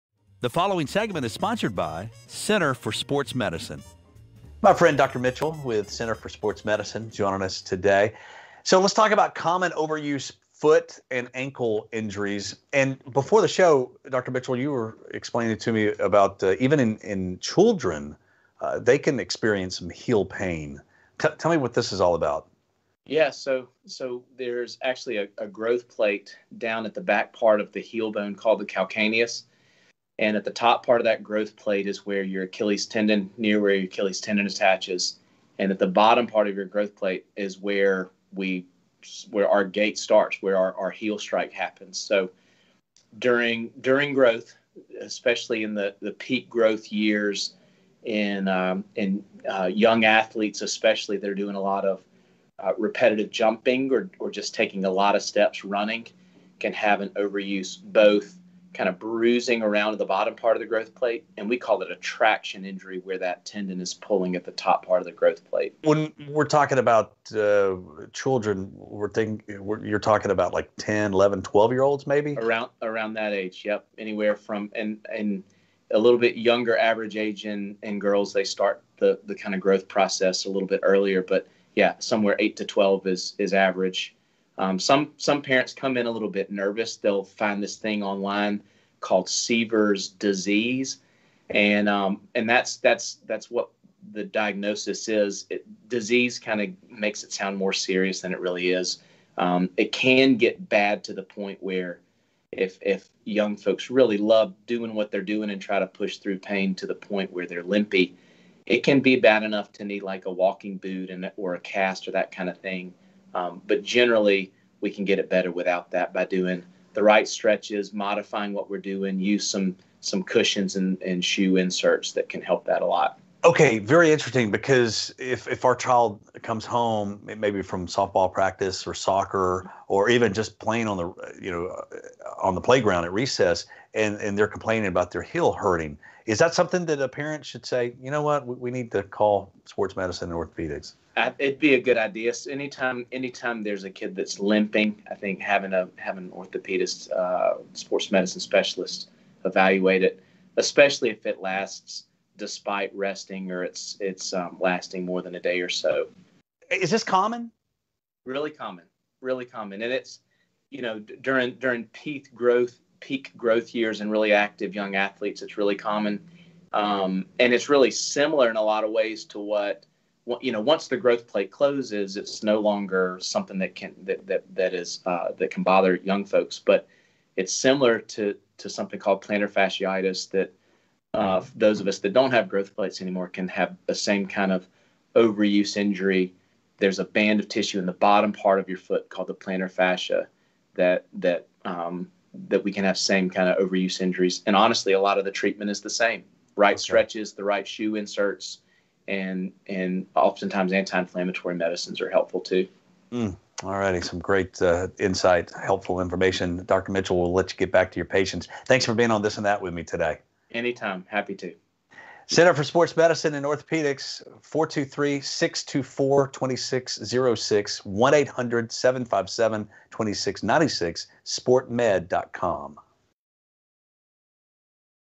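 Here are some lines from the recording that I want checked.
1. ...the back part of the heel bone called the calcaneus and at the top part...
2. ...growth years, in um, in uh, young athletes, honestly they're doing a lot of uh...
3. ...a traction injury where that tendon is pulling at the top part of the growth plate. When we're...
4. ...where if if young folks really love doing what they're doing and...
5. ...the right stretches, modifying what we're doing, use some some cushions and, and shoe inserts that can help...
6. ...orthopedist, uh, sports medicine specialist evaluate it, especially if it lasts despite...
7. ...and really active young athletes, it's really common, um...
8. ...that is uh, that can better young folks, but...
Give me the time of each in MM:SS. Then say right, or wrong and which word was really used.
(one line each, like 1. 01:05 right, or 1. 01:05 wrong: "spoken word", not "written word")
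1. 00:26 right
2. 00:46 wrong: "especially", not "honestly"
3. 01:01 right
4. 01:41 right
5. 01:56 right
6. 02:26 right
7. 02:44 right
8. 02:54 wrong: "bother", not "better".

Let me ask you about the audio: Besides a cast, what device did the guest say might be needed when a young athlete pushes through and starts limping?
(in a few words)
walking boot.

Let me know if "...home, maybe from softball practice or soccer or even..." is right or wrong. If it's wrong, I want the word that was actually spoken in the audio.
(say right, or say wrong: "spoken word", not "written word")
right.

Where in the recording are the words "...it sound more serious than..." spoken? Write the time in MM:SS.
01:37.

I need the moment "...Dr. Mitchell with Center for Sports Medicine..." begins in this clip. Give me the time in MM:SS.
00:04.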